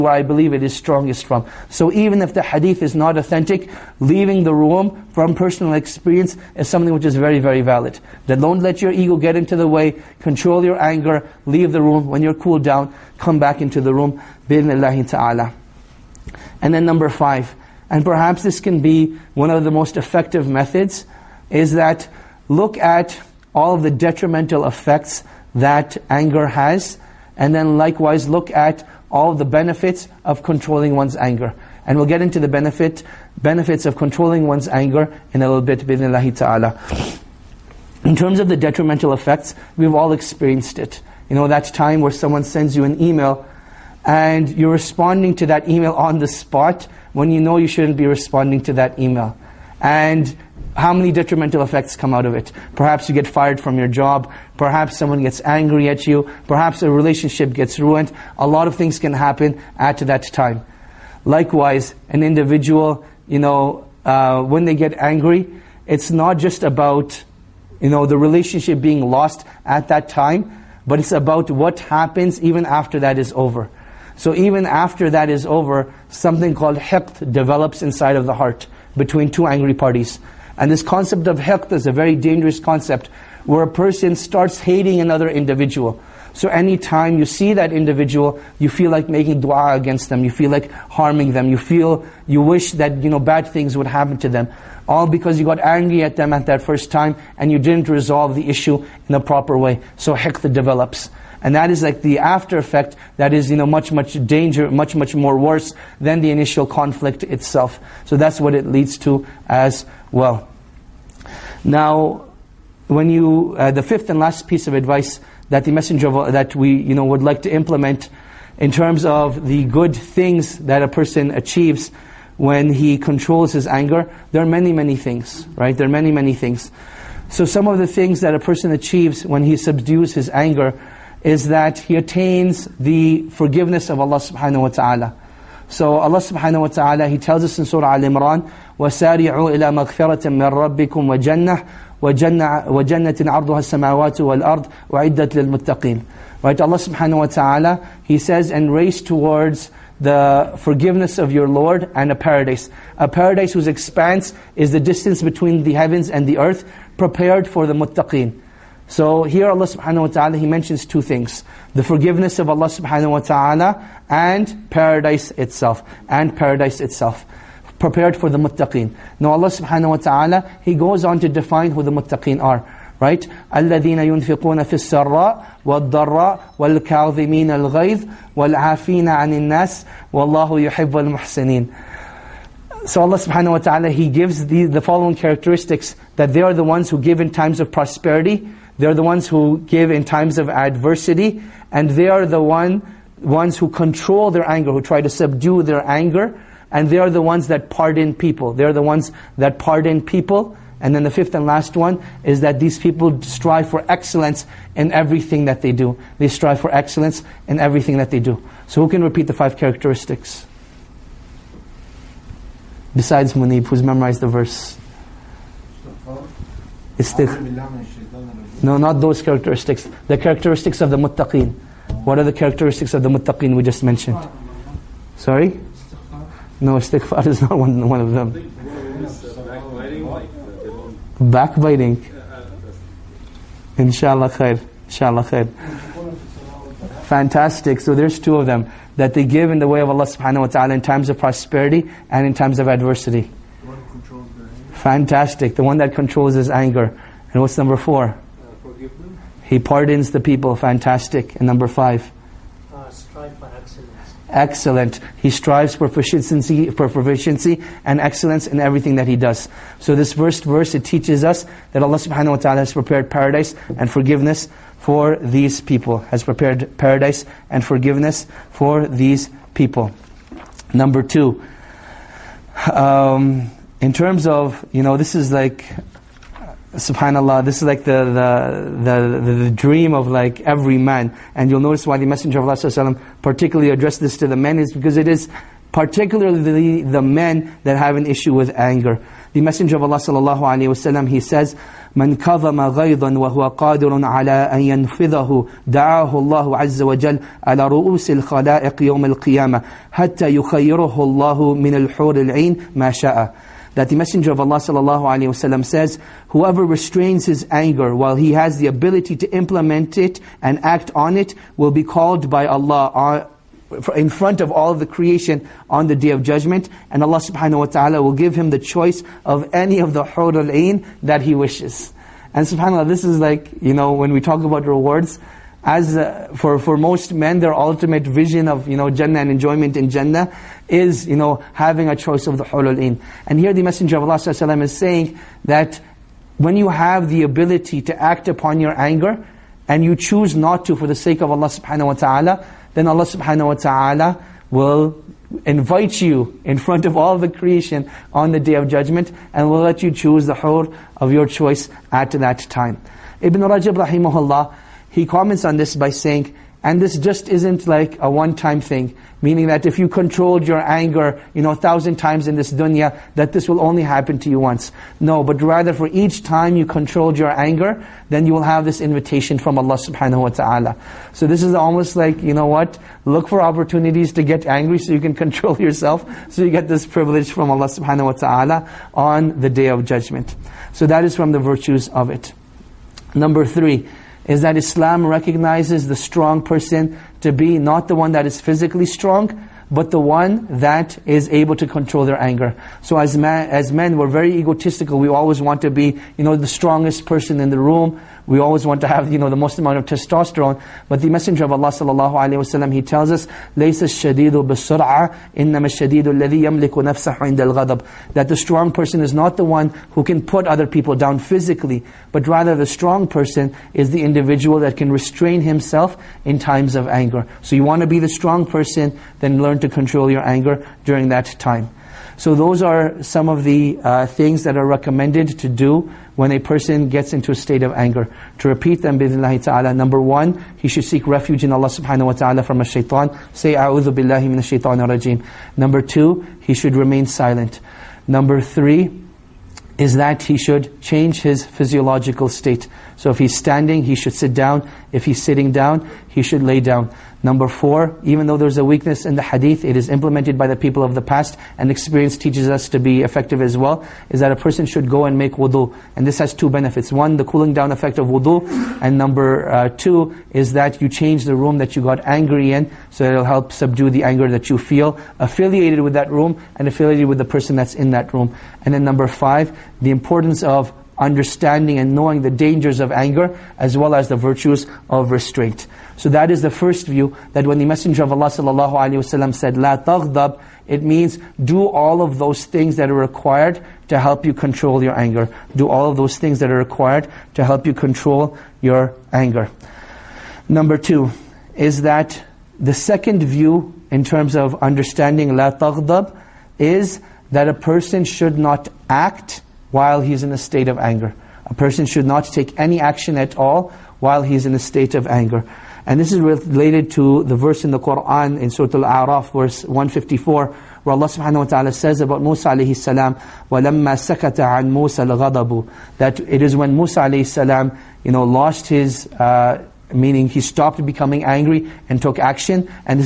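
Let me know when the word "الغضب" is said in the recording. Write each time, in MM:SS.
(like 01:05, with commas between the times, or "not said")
06:47, 08:35.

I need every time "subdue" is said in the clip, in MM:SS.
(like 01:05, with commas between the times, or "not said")
02:09, 03:15, 07:43.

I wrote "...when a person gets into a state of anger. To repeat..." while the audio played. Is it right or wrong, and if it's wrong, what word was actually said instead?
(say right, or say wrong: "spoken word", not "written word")
right.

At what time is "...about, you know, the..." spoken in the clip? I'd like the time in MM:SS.
01:06.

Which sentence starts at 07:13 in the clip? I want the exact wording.
Say, a'udhu billahi min shaitan rajim.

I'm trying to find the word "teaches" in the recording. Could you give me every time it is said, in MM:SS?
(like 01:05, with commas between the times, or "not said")
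04:20, 07:32.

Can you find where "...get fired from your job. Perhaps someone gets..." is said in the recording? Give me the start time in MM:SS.
00:53.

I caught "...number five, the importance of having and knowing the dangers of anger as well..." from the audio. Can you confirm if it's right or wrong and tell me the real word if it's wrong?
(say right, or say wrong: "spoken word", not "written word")
wrong: "understanding", not "having".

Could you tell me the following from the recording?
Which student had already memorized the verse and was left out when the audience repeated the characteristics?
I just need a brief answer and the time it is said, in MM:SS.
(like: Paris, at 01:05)
Munib, at 03:33.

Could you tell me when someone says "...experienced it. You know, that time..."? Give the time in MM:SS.
00:40.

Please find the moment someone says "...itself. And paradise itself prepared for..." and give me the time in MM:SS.
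02:45.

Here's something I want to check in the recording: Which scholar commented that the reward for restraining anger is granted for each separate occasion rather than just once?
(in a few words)
Ibn Rajab.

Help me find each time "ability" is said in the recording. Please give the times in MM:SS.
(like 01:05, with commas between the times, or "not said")
05:08, 05:37.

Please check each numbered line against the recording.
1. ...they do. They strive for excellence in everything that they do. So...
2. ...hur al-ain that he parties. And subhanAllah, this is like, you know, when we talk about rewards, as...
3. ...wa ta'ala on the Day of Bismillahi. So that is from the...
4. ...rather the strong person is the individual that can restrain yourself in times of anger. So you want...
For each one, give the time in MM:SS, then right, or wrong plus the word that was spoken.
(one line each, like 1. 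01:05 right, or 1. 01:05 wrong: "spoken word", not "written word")
1. 03:25 right
2. 05:20 wrong: "wishes", not "parties"
3. 06:18 wrong: "Judgment", not "Bismillahi"
4. 06:52 wrong: "himself", not "yourself".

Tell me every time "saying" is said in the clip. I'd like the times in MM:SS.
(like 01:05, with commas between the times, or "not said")
05:34, 05:55.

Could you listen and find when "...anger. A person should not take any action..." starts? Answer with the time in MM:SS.
08:20.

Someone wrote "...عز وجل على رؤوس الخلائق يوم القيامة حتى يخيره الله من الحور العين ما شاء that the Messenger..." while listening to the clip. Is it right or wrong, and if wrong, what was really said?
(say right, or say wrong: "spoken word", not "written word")
right.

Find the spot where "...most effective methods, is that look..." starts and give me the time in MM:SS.
00:19.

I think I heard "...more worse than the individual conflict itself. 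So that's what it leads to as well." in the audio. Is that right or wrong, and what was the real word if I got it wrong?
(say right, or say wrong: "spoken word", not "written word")
wrong: "initial", not "individual".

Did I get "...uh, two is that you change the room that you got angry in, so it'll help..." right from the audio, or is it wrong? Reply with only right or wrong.
right.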